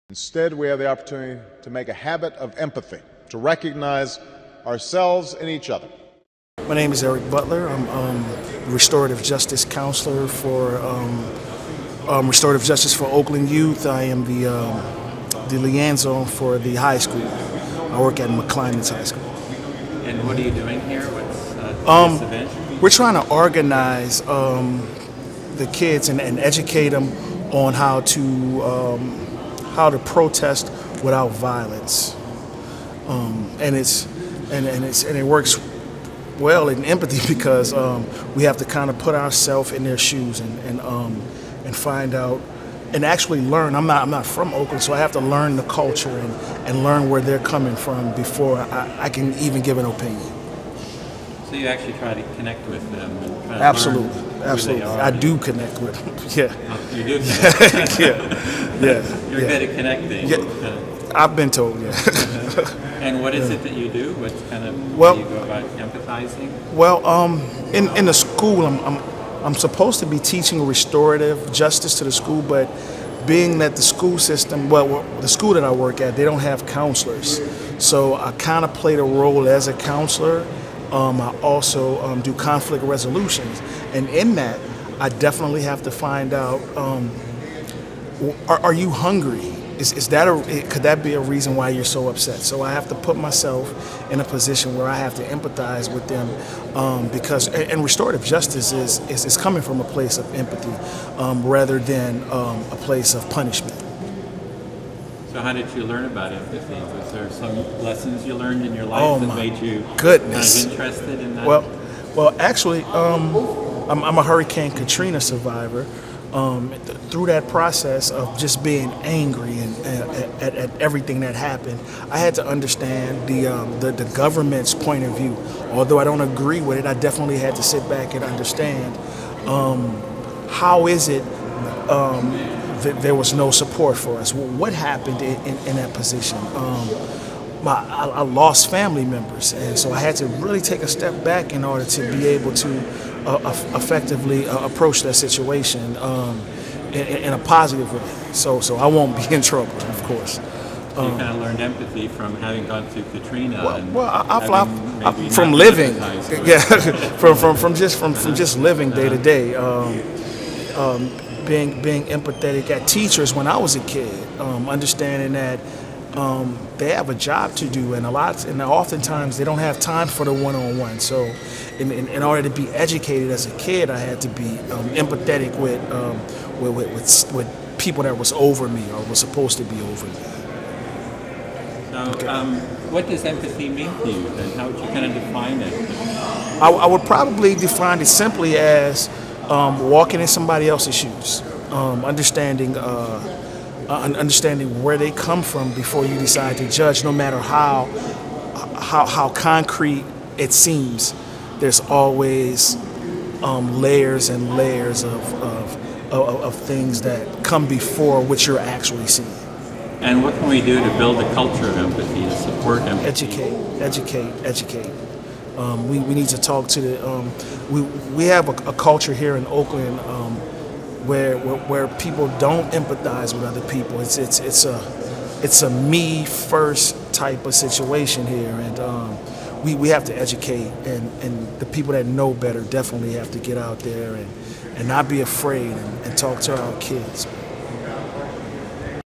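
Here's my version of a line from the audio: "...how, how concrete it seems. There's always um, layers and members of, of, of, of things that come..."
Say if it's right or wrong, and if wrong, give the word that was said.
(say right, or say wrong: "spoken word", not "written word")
wrong: "layers", not "members".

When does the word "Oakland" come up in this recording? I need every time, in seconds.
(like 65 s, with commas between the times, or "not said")
13 s, 44 s, 219 s.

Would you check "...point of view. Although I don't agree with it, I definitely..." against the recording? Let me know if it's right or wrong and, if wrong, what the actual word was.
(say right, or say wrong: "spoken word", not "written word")
right.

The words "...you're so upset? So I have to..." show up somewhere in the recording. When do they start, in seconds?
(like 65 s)
91 s.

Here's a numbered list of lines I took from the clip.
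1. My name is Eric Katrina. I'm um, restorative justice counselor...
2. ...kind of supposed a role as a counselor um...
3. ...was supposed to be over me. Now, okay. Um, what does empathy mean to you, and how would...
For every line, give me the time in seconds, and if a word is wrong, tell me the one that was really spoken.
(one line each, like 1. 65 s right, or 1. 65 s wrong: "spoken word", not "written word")
1. 6 s wrong: "Butler", not "Katrina"
2. 78 s wrong: "played", not "supposed"
3. 179 s right.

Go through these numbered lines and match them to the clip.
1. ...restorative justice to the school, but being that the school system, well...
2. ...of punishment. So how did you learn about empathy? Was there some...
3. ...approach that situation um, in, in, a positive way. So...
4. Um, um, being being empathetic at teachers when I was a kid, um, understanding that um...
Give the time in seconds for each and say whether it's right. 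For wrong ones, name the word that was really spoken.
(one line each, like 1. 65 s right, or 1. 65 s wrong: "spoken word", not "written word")
1. 70 s right
2. 103 s right
3. 144 s right
4. 159 s right.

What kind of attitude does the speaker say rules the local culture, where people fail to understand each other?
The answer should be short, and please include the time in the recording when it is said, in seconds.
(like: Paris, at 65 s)
me first, at 225 s.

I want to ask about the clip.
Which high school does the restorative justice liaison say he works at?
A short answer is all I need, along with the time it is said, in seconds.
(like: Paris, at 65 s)
McClymonds High School, at 18 s.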